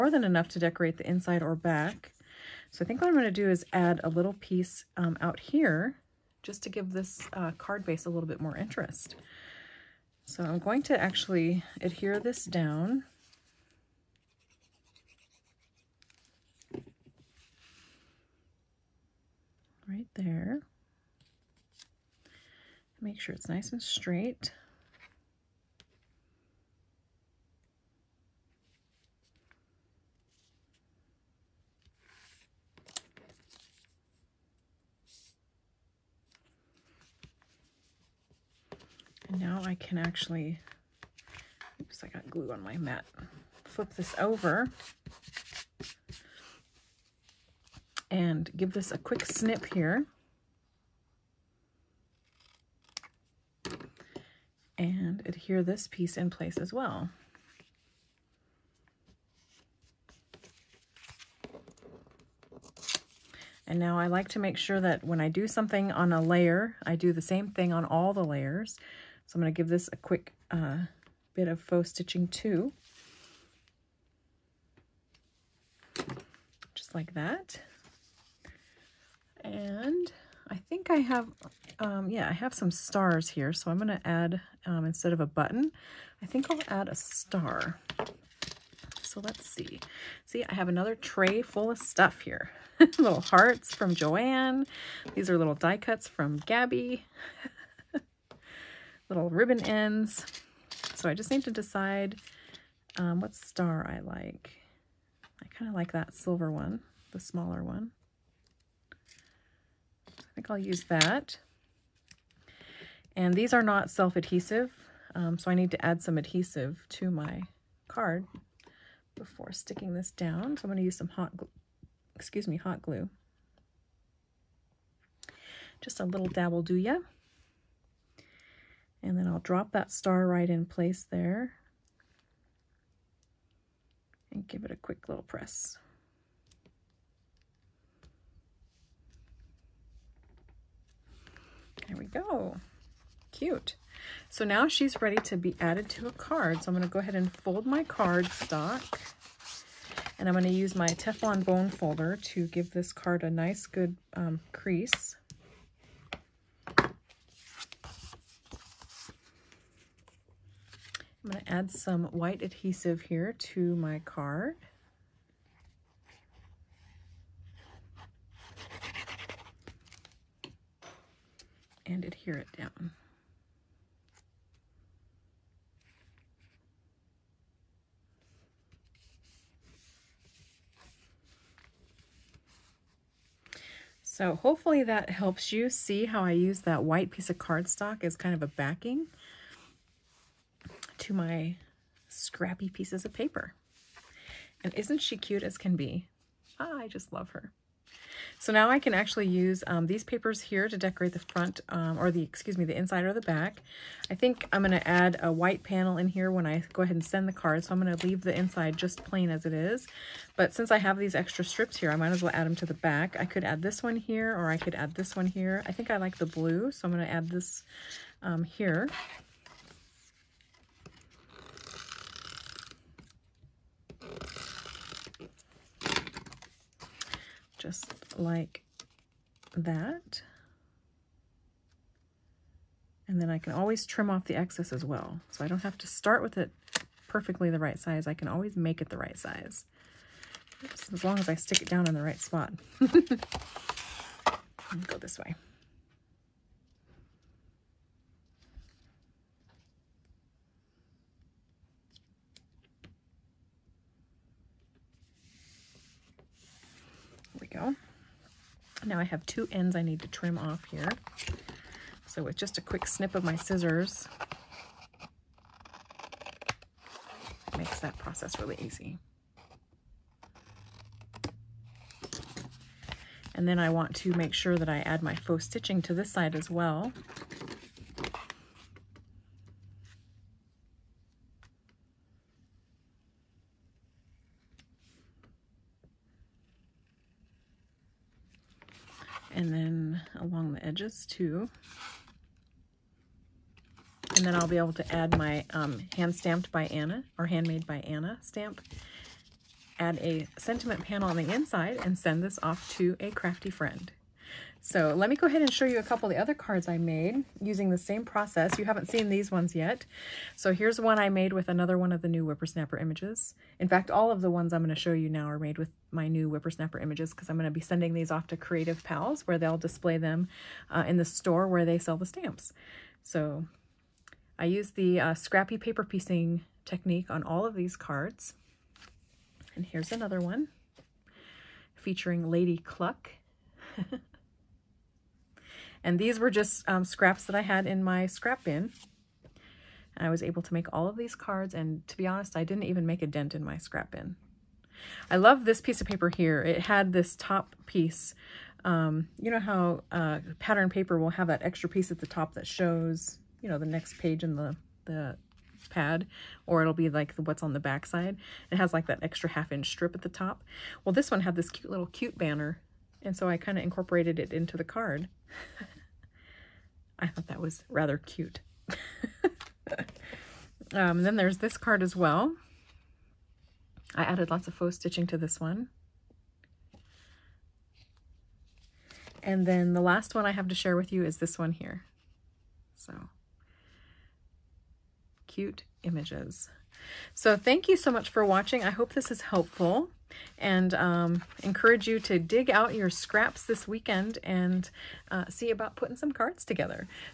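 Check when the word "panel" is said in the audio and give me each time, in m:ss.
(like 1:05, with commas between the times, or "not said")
3:25, 5:00.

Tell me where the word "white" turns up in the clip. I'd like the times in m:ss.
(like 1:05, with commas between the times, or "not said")
2:42, 3:06, 3:25.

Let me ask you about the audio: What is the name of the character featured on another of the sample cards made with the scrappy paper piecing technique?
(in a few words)
Lady Cluck.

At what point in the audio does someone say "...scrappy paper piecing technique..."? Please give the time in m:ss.
5:25.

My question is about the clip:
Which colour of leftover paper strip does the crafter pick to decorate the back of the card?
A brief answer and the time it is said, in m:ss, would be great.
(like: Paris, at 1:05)
blue, at 3:36.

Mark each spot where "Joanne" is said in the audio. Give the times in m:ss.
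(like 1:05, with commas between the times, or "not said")
1:33.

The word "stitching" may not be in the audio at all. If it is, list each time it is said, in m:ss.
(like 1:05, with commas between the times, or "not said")
1:11, 4:35, 6:14.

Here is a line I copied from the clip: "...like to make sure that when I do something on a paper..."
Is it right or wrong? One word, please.
wrong.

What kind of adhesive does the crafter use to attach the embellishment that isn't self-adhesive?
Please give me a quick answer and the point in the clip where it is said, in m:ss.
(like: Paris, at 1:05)
hot glue, at 2:02.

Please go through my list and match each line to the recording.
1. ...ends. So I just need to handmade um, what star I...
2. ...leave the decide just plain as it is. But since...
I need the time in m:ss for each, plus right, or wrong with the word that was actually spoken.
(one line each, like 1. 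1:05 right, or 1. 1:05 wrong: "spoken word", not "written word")
1. 1:39 wrong: "decide", not "handmade"
2. 3:28 wrong: "inside", not "decide".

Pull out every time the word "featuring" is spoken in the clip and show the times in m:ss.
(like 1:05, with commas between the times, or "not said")
5:31.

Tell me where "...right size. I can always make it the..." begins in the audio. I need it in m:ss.
3:57.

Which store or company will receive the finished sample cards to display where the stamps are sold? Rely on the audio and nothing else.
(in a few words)
Creative Pals.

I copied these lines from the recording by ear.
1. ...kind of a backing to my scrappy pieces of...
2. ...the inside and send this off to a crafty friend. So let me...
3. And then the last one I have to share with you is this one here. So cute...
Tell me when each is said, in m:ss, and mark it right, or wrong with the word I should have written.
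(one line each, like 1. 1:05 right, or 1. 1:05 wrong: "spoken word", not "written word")
1. 3:08 right
2. 5:01 right
3. 6:19 right.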